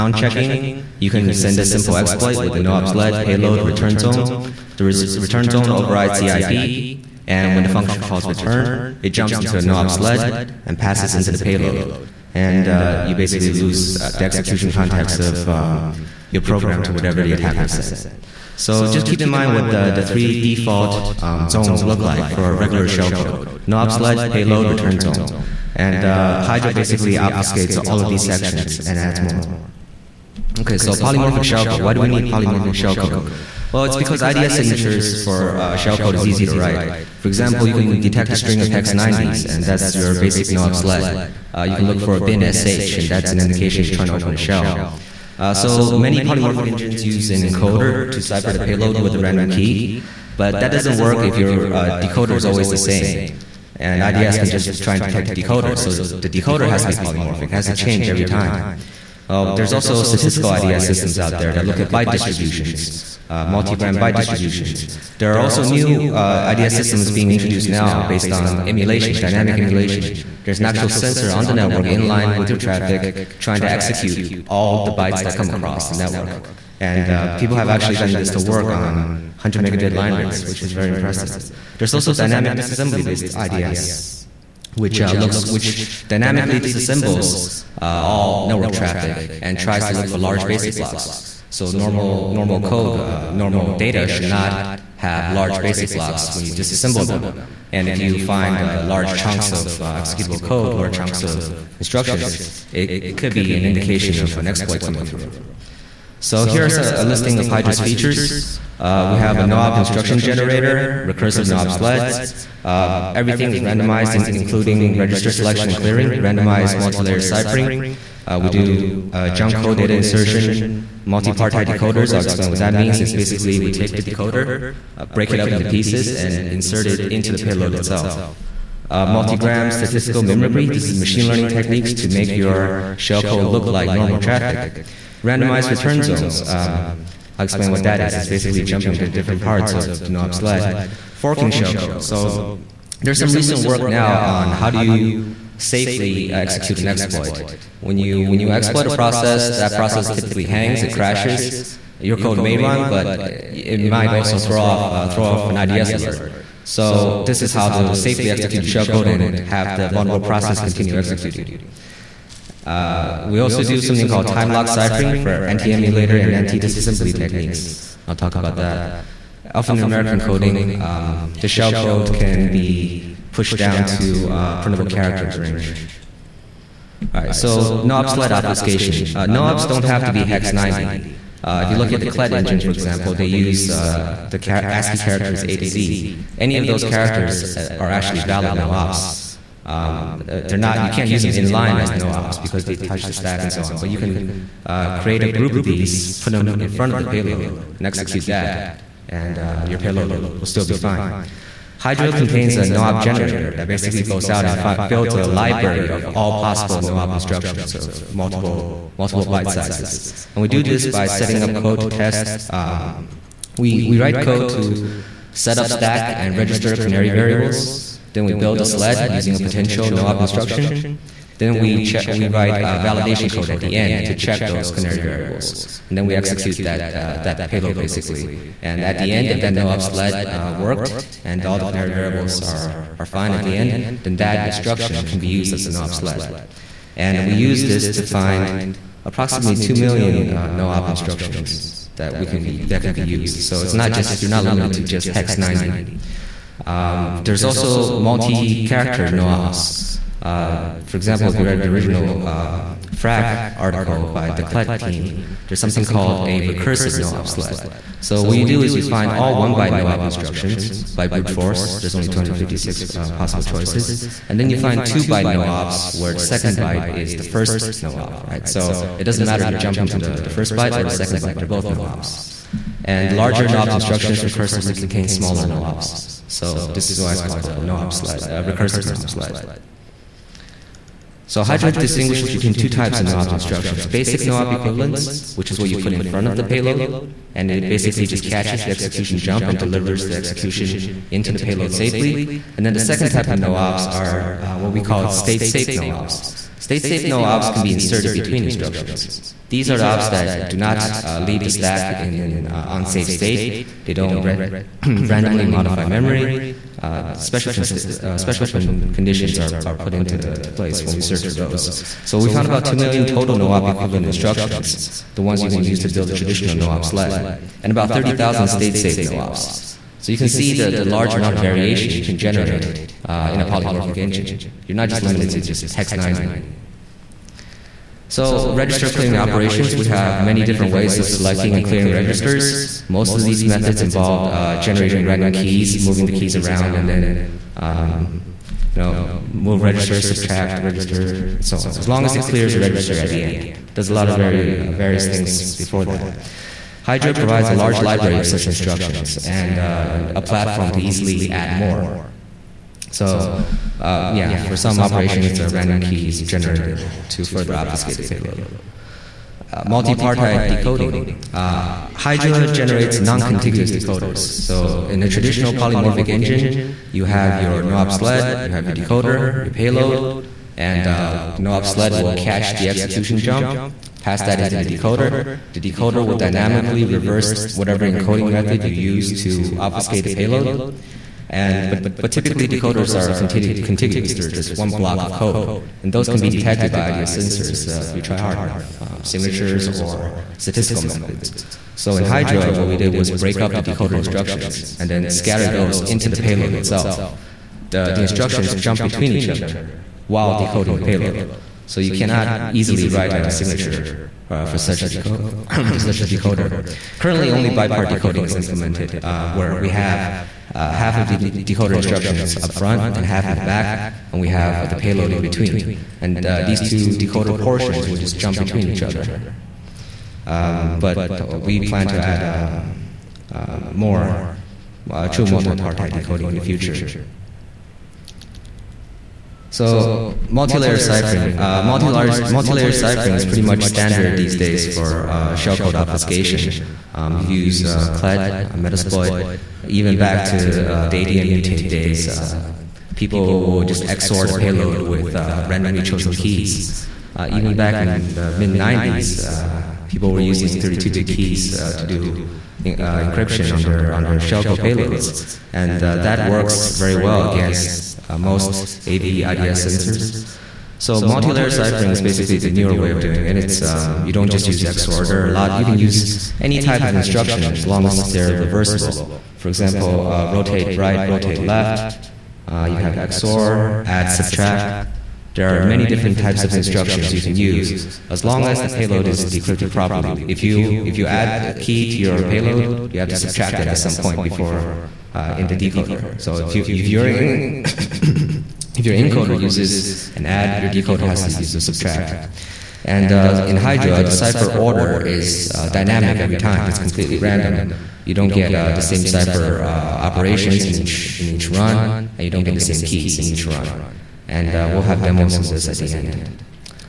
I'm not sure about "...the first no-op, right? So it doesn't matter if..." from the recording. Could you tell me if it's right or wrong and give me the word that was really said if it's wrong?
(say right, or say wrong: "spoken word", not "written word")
right.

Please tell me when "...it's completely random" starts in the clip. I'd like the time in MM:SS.
08:16.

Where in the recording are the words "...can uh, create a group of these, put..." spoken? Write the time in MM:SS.
03:13.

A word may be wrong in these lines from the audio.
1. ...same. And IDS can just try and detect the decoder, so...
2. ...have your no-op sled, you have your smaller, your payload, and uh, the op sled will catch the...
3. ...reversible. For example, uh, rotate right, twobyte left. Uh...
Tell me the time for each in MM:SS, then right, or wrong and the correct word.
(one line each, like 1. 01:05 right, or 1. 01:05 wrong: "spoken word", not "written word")
1. 00:52 right
2. 06:07 wrong: "decoder", not "smaller"
3. 07:48 wrong: "rotate", not "twobyte".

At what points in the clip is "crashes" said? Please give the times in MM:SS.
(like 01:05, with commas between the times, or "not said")
02:30.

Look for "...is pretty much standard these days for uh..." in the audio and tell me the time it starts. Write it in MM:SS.
07:13.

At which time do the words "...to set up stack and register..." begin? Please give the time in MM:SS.
03:34.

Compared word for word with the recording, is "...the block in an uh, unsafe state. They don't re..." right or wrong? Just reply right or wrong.
wrong.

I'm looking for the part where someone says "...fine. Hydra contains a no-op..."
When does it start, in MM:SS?
03:20.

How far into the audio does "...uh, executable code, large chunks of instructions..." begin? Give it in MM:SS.
01:39.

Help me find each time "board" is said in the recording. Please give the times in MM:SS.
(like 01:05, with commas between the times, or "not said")
not said.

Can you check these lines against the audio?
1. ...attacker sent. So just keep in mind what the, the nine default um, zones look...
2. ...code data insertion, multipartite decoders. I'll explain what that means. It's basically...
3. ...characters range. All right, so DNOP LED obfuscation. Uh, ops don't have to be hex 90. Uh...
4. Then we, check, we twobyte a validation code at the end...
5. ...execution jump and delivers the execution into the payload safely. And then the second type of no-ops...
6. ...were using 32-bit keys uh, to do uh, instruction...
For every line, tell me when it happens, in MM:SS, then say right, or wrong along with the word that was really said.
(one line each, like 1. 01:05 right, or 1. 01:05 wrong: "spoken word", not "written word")
1. 00:17 wrong: "three", not "nine"
2. 01:59 right
3. 02:54 wrong: "NOPS", not "DNOP"
4. 03:41 wrong: "write", not "twobyte"
5. 04:48 right
6. 07:30 wrong: "encryption", not "instruction".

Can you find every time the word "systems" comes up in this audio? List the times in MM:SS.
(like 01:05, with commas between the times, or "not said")
01:00, 01:06.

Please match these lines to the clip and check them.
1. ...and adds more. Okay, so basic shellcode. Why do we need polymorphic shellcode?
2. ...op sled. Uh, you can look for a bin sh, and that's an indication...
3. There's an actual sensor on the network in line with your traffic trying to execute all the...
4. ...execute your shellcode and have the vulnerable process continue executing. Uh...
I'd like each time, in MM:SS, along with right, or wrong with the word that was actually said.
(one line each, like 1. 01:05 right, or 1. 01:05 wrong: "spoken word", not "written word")
1. 00:28 wrong: "polymorphic", not "basic"
2. 00:40 right
3. 01:10 right
4. 02:38 right.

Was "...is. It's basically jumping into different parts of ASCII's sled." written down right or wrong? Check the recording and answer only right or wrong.
wrong.